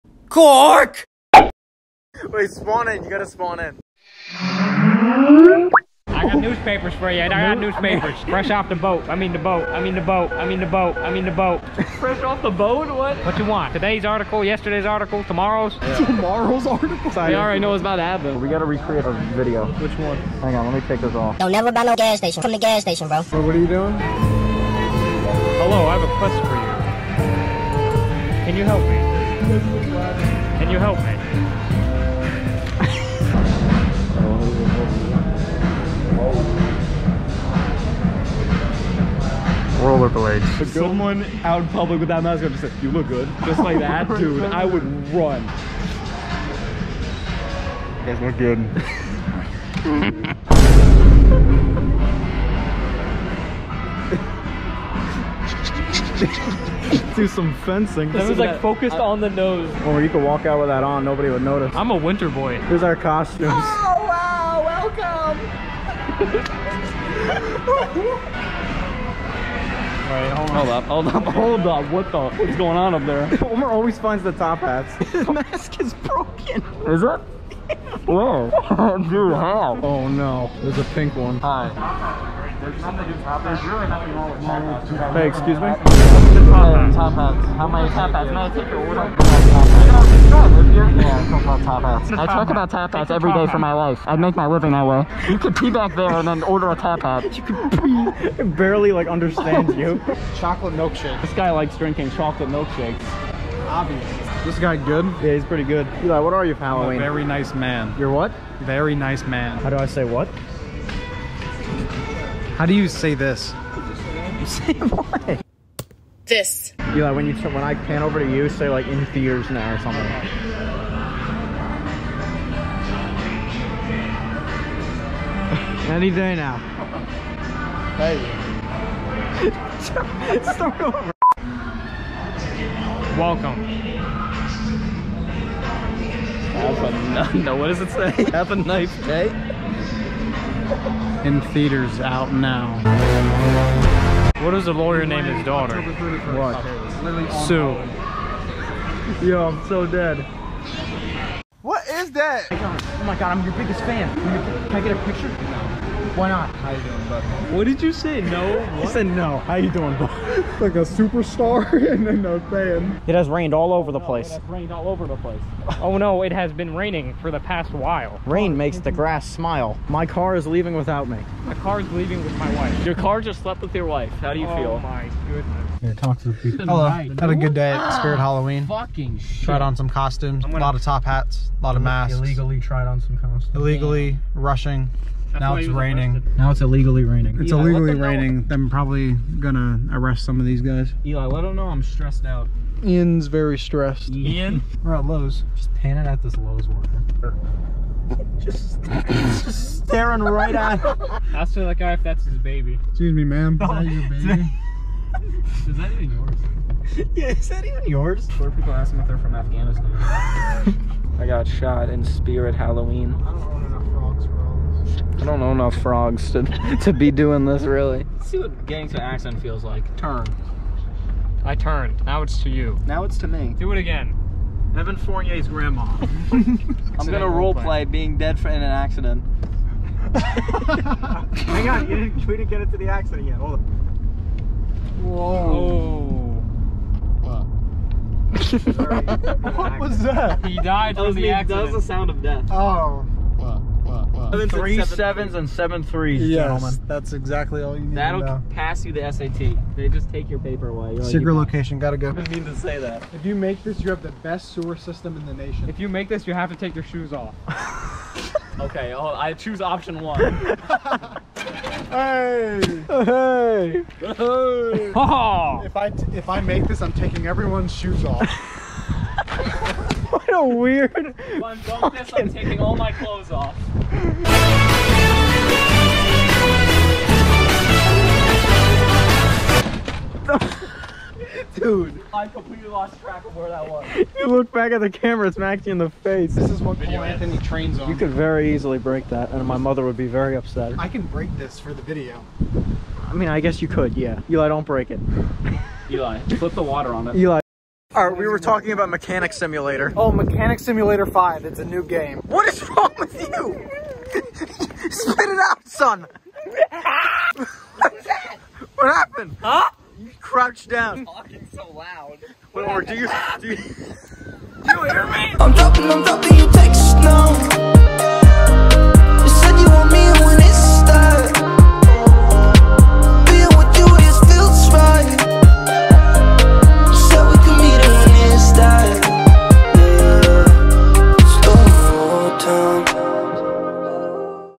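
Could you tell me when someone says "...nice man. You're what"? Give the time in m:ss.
1:47.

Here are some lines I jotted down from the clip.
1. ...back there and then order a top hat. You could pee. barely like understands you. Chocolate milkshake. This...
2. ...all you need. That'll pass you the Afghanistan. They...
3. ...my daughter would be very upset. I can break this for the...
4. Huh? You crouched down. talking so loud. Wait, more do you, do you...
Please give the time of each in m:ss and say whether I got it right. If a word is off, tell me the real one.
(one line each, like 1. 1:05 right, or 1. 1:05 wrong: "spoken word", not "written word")
1. 1:35 right
2. 4:07 wrong: "SAT", not "Afghanistan"
3. 4:49 wrong: "mother", not "daughter"
4. 5:09 right.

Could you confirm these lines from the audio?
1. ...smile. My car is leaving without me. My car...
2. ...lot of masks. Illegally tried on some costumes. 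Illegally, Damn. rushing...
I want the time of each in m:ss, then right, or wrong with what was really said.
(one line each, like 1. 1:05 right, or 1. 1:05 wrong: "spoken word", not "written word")
1. 2:49 right
2. 3:01 right.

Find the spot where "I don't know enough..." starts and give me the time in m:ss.
3:35.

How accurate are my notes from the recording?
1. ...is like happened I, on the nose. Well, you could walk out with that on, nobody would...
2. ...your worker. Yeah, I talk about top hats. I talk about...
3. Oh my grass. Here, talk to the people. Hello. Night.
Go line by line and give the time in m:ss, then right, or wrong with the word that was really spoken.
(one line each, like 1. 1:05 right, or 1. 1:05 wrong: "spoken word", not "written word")
1. 0:58 wrong: "focused", not "happened"
2. 1:28 wrong: "order", not "worker"
3. 2:54 wrong: "goodness", not "grass".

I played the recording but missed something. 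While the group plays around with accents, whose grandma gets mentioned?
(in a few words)
Evan Fournier's.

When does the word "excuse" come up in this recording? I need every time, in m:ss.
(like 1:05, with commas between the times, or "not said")
1:25, 3:22.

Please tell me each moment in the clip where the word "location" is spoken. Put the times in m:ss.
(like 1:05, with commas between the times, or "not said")
4:11.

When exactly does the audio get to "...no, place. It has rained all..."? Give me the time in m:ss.
2:43.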